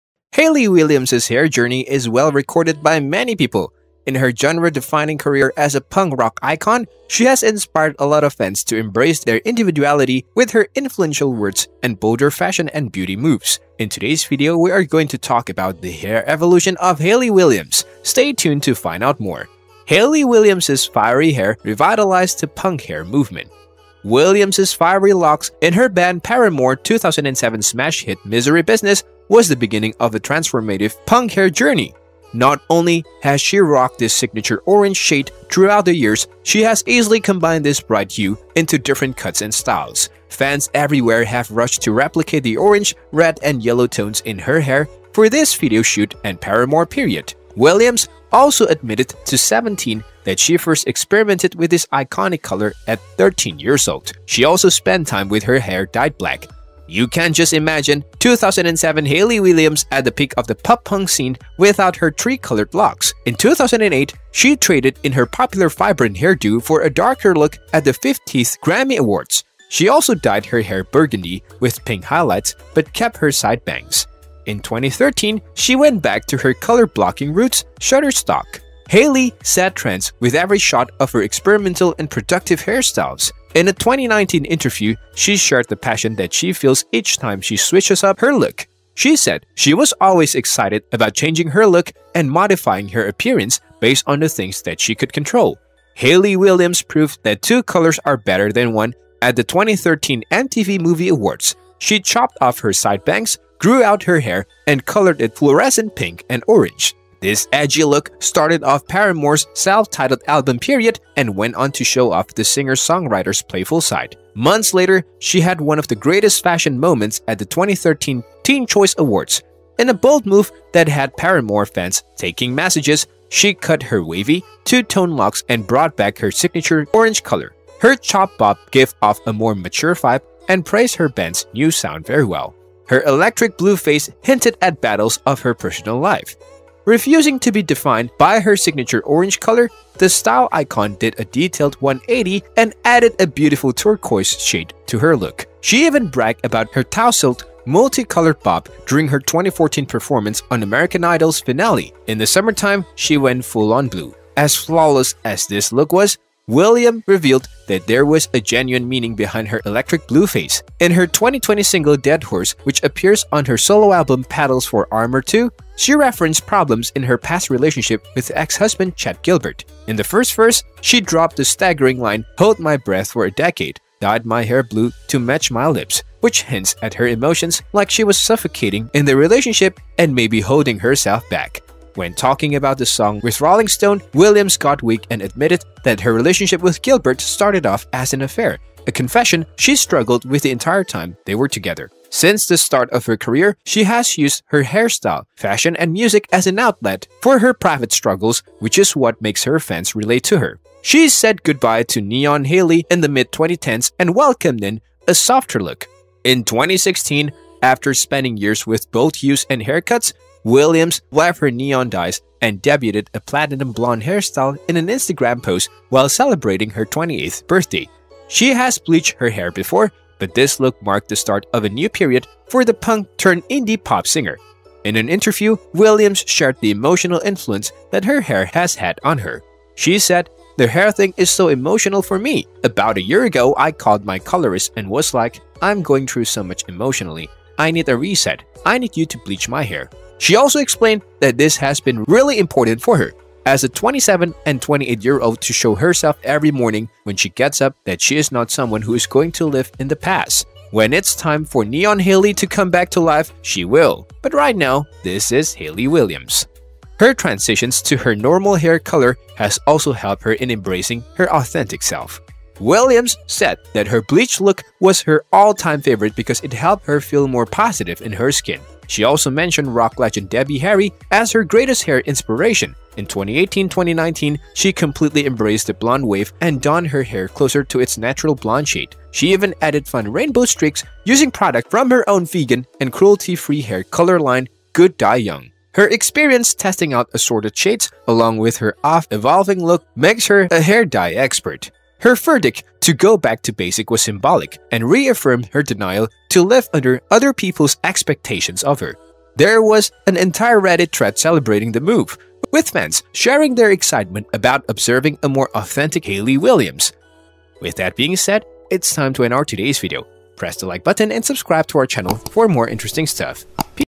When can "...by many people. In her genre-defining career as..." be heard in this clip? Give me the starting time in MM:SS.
00:02.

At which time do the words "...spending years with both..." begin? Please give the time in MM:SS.
03:27.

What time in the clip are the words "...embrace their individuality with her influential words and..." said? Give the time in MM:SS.
00:08.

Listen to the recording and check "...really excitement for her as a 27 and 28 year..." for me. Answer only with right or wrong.
wrong.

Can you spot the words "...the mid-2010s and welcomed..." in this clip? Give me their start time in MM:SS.
03:22.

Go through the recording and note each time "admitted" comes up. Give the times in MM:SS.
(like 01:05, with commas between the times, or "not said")
00:48, 03:05.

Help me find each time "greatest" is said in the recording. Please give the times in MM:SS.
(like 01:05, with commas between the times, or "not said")
01:55, 04:31.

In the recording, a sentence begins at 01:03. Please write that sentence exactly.
In 2008, she traded in her popular vibrant hairdo for a darker look at the 50th Grammy Awards.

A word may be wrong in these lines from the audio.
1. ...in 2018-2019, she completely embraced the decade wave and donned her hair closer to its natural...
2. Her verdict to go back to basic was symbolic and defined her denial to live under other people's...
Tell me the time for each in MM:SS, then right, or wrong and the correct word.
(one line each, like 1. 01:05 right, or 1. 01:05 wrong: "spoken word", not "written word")
1. 04:32 wrong: "blonde", not "decade"
2. 04:52 wrong: "reaffirmed", not "defined".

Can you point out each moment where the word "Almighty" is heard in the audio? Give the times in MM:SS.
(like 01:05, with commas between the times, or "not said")
not said.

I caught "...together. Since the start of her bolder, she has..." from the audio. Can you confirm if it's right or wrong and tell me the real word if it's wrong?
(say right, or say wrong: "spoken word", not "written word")
wrong: "career", not "bolder".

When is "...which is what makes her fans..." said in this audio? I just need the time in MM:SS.
03:18.